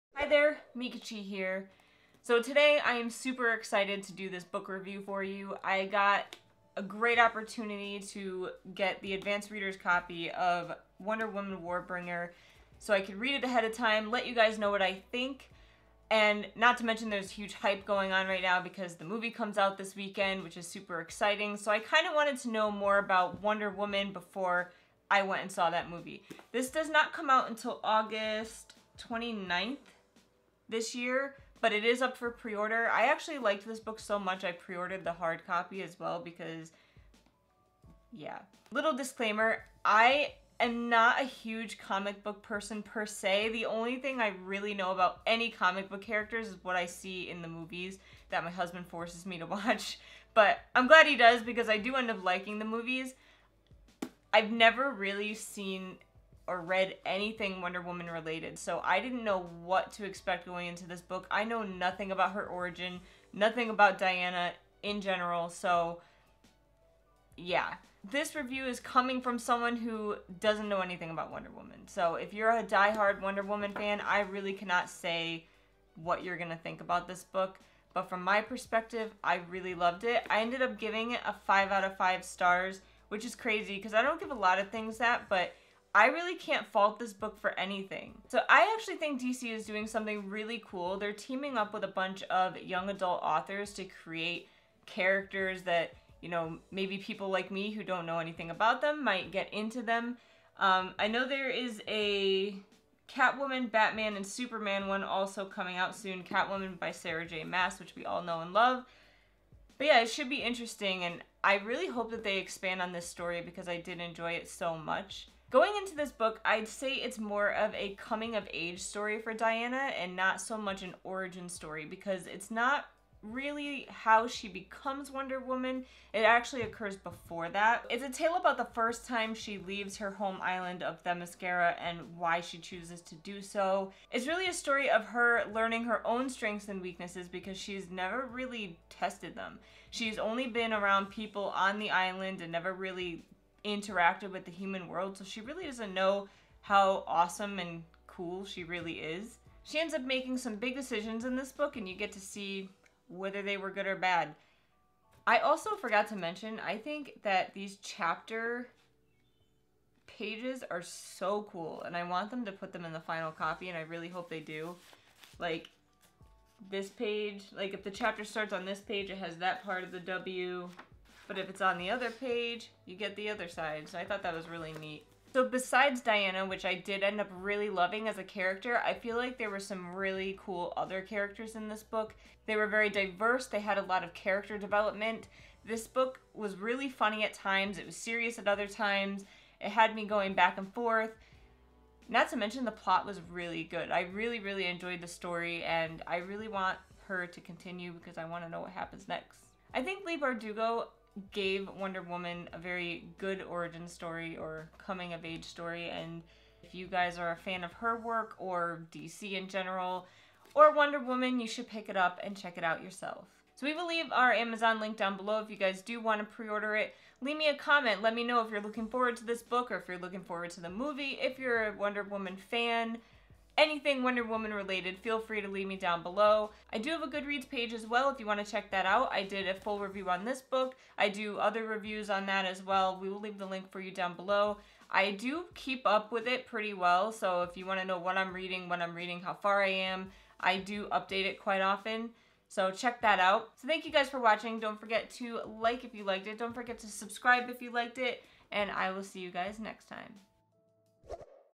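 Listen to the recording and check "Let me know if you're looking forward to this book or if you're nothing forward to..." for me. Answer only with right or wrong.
wrong.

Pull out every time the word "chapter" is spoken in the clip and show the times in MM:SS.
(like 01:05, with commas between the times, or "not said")
02:37, 02:47.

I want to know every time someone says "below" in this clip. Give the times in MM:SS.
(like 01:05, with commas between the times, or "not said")
03:35, 03:46, 03:54.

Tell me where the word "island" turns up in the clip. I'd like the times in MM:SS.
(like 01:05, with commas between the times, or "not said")
02:10, 02:21.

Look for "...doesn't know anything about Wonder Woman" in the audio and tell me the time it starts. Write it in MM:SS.
01:10.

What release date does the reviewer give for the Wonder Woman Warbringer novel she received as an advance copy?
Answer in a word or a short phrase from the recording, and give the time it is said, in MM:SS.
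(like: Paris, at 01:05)
August 29th, at 00:27.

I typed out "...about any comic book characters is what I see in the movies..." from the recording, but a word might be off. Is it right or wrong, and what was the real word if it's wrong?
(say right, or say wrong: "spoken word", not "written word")
right.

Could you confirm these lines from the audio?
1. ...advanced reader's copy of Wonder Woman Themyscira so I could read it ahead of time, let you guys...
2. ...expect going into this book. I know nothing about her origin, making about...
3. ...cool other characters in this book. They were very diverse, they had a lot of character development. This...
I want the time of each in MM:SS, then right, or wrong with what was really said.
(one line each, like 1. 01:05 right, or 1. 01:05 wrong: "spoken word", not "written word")
1. 00:09 wrong: "Warbringer", not "Themyscira"
2. 01:00 wrong: "nothing", not "making"
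3. 03:00 right.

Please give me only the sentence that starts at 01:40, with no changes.
Um, I know there is a Catwoman, Batman, and Superman one also coming out soon.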